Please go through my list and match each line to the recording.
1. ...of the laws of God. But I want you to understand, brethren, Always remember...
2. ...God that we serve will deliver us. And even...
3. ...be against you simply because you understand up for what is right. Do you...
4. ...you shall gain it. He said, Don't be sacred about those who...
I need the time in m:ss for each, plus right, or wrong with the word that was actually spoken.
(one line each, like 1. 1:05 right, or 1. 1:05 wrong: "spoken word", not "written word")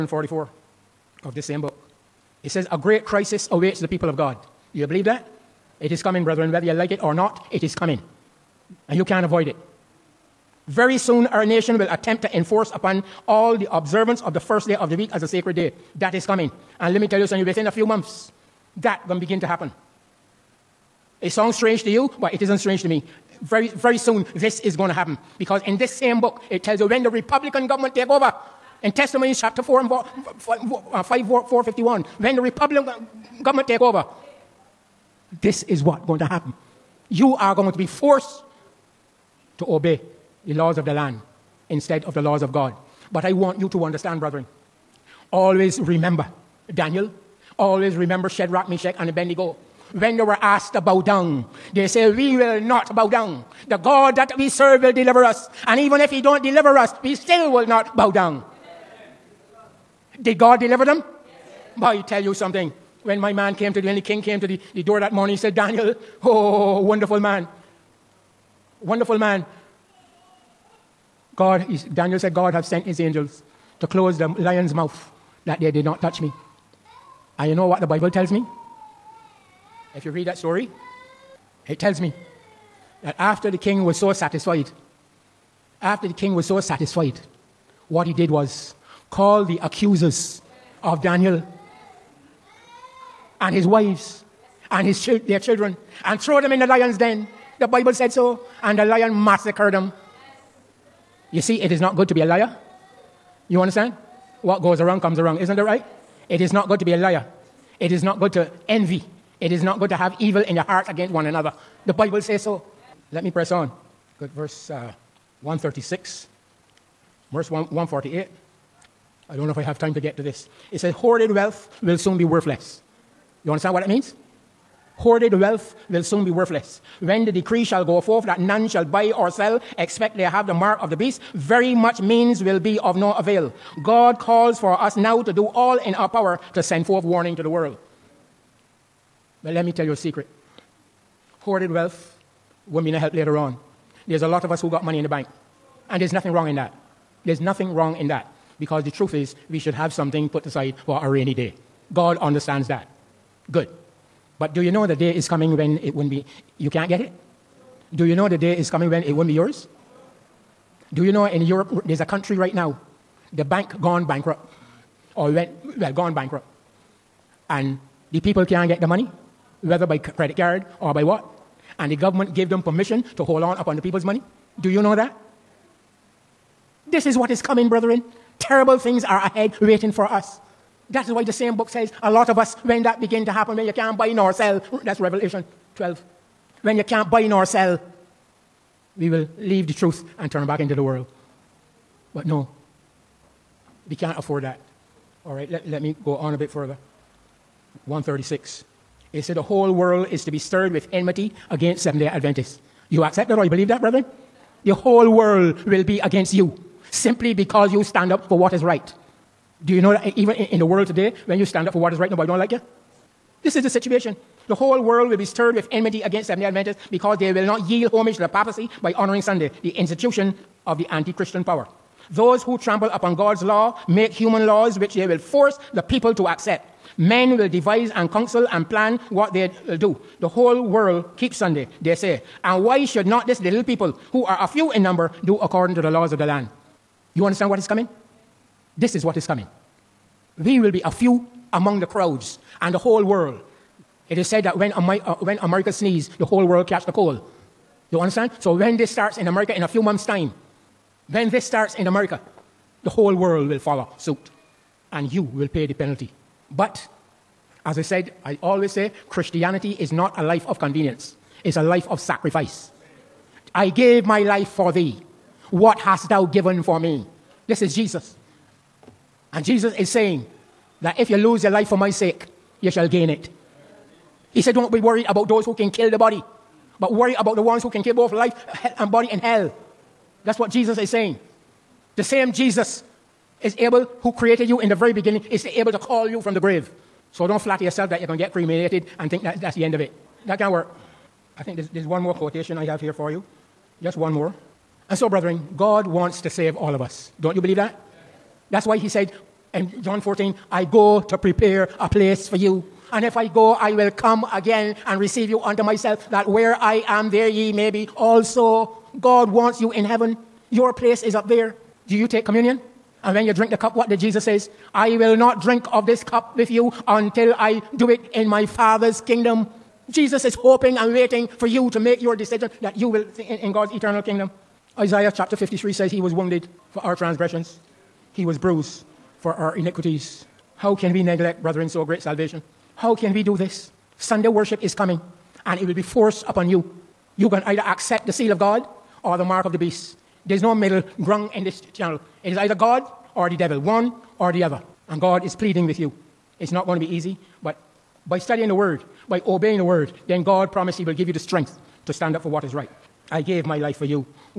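1. 0:42 right
2. 0:53 right
3. 3:25 wrong: "stand", not "understand"
4. 4:32 wrong: "worried", not "sacred".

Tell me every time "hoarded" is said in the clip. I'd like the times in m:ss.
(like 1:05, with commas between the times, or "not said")
2:00, 2:04, 2:21.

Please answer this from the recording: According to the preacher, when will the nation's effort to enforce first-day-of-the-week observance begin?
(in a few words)
within a few months.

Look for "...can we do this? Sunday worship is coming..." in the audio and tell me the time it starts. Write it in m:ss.
5:32.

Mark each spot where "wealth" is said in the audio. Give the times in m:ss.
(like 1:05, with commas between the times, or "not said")
2:01, 2:05, 2:21.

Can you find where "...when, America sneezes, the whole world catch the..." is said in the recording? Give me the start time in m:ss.
4:05.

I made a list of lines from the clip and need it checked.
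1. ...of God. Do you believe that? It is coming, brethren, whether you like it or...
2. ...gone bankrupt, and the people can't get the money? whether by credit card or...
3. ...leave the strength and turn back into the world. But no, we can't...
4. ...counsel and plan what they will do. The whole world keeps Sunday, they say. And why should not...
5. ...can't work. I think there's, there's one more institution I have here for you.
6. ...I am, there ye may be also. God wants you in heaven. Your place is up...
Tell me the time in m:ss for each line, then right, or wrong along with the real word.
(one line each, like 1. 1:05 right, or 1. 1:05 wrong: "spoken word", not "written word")
1. 0:04 right
2. 2:45 right
3. 3:09 wrong: "truth", not "strength"
4. 3:48 right
5. 4:50 wrong: "quotation", not "institution"
6. 5:06 right.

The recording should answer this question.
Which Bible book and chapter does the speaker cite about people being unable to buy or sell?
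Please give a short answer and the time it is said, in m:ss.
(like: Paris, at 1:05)
Revelation 12, at 3:04.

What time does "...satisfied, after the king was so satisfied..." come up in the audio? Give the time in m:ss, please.
1:24.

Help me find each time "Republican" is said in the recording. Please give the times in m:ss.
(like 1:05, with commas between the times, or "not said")
0:27, 0:32.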